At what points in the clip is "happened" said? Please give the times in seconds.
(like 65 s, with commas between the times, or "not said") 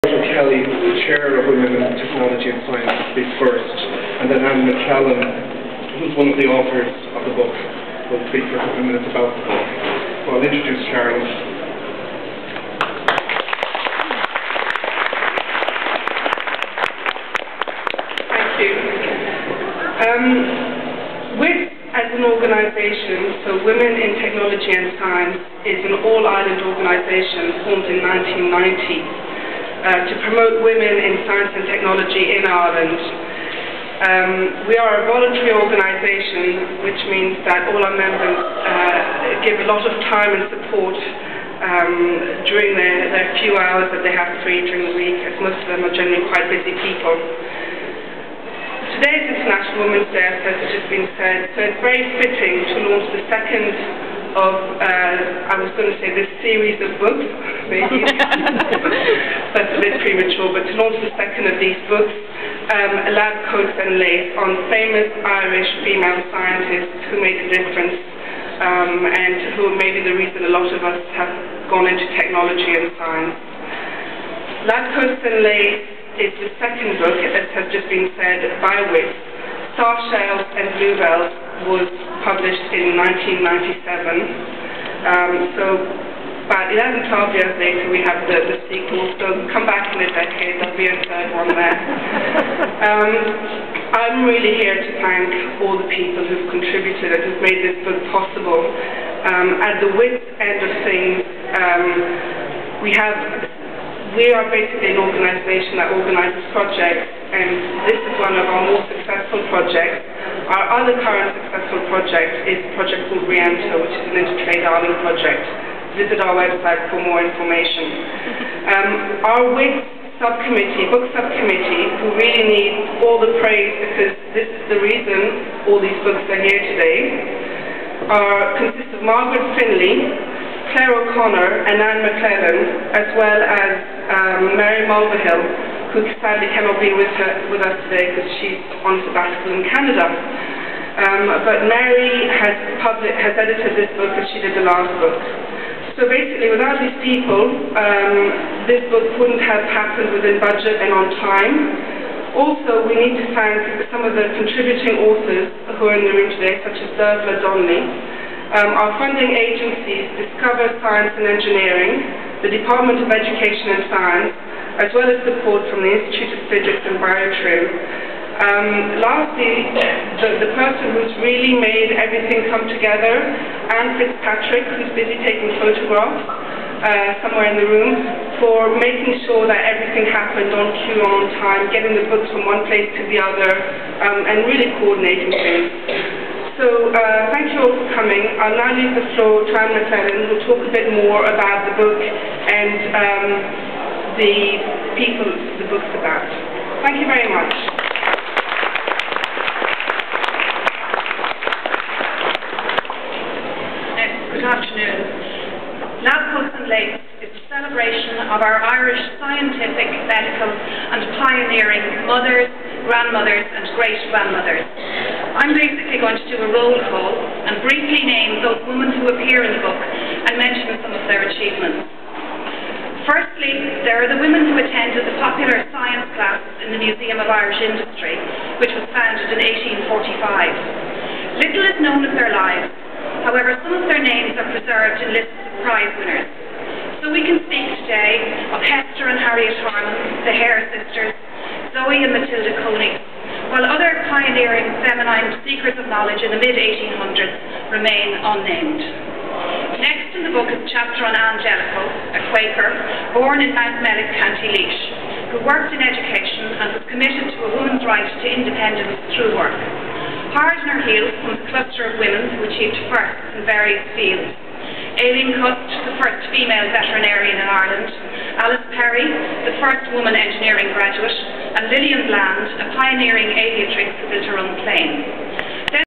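149 s, 180 s.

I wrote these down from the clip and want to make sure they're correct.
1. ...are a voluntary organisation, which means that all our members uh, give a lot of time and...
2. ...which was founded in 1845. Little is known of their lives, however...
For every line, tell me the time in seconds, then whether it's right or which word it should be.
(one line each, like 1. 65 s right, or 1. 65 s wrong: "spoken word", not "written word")
1. 34 s right
2. 228 s right.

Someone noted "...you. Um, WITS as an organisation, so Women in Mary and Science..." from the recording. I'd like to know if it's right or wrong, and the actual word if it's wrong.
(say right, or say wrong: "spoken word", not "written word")
wrong: "Technology", not "Mary".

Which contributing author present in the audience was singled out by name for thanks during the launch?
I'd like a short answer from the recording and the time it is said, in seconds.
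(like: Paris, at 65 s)
Dervilla Donnelly, at 156 s.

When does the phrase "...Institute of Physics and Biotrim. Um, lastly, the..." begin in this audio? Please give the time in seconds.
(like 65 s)
165 s.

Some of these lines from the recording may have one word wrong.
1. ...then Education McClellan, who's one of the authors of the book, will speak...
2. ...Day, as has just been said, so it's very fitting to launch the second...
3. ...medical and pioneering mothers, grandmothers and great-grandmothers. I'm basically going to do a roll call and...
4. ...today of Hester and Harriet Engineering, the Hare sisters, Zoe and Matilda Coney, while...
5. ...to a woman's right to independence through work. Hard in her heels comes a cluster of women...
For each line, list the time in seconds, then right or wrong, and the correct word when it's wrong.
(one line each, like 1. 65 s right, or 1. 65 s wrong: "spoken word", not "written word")
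1. 4 s wrong: "Anne", not "Education"
2. 50 s right
3. 210 s right
4. 237 s wrong: "Harman", not "Engineering"
5. 257 s right.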